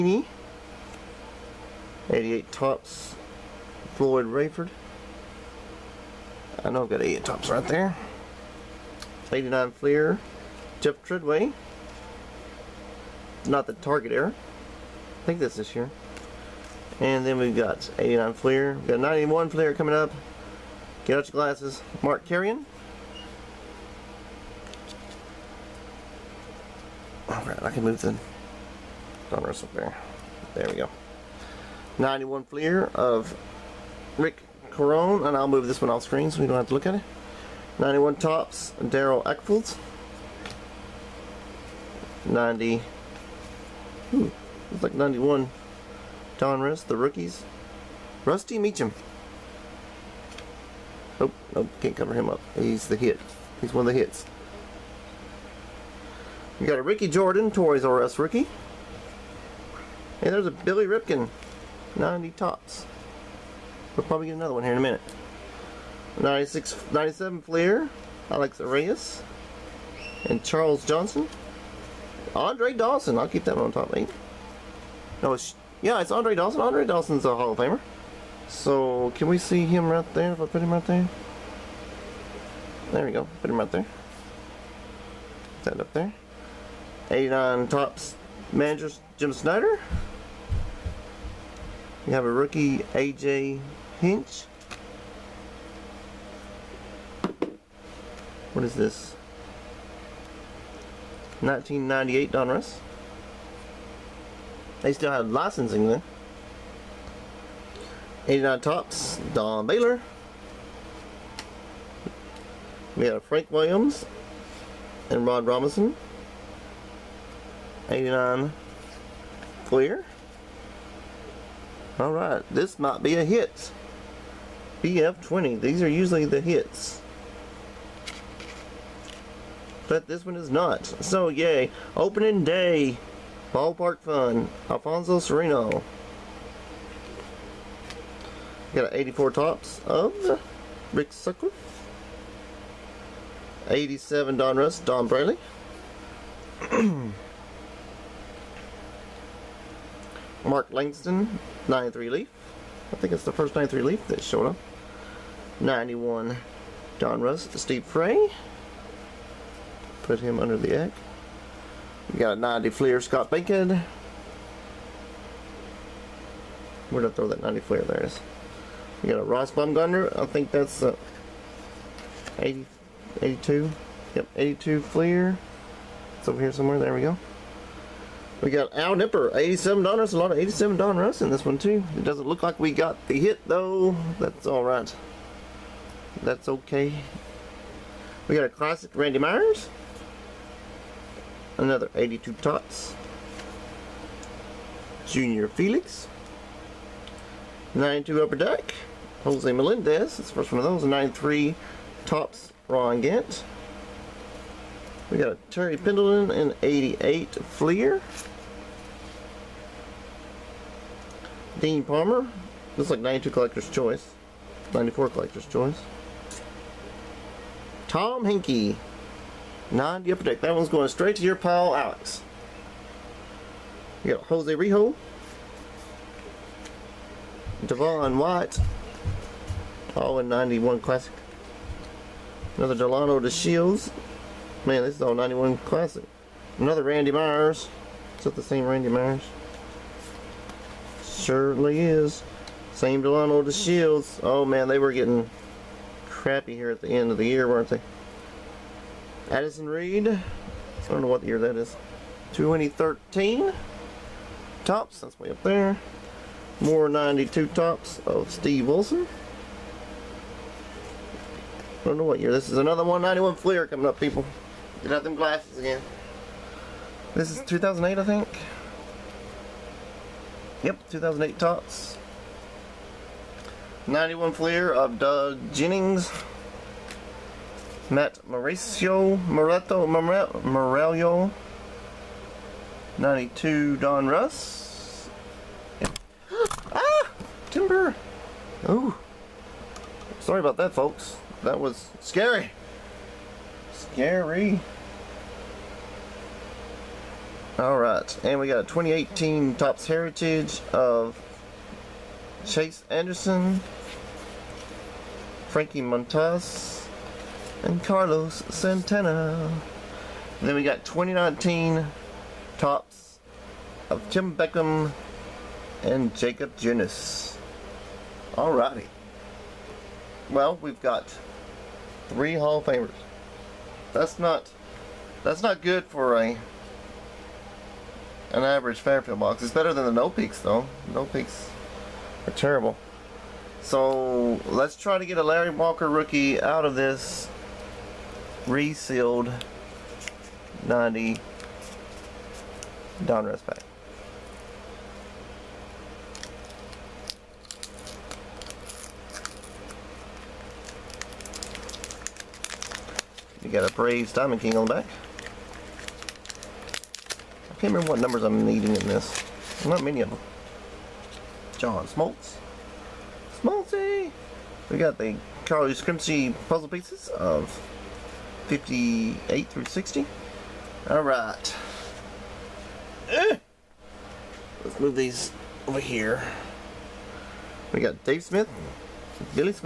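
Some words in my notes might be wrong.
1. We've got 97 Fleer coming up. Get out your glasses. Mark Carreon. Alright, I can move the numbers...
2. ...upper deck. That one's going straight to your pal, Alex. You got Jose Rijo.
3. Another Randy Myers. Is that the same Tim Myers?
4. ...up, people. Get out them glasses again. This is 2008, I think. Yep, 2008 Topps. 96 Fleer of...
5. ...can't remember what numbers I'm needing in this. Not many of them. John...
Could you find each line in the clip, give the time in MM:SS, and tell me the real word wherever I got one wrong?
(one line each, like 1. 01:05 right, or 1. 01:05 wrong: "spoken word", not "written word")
1. 00:18 wrong: "91", not "97"
2. 03:40 right
3. 03:56 wrong: "Randy", not "Tim"
4. 04:23 wrong: "91", not "96"
5. 05:57 right.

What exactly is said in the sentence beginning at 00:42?
90, hmm, ooh, it's like 91, Donruss, the rookies.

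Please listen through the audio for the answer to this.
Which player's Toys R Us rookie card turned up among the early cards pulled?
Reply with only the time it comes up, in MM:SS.
00:56.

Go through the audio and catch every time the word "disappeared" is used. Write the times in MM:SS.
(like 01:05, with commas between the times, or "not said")
not said.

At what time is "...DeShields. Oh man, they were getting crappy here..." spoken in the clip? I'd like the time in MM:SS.
04:03.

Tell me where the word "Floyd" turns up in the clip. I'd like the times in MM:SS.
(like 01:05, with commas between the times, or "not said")
00:03.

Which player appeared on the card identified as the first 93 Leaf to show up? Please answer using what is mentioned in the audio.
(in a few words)
Mark Langston.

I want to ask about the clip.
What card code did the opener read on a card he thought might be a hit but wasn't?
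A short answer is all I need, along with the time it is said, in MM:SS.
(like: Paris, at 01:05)
BF20, at 02:04.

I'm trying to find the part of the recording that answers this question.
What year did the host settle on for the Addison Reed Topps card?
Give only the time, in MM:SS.
04:12.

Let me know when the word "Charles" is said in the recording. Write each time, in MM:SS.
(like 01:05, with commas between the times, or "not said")
01:10.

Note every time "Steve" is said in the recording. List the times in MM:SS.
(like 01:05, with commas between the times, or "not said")
02:37, 04:18.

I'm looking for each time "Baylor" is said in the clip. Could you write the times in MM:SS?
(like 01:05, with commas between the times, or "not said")
01:49.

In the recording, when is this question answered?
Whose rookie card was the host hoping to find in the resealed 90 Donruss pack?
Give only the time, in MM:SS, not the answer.
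05:35.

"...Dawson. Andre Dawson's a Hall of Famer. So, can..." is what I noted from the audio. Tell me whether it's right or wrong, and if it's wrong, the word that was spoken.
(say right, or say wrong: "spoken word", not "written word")
right.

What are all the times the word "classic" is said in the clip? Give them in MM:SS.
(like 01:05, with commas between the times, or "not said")
03:08, 03:50, 03:55.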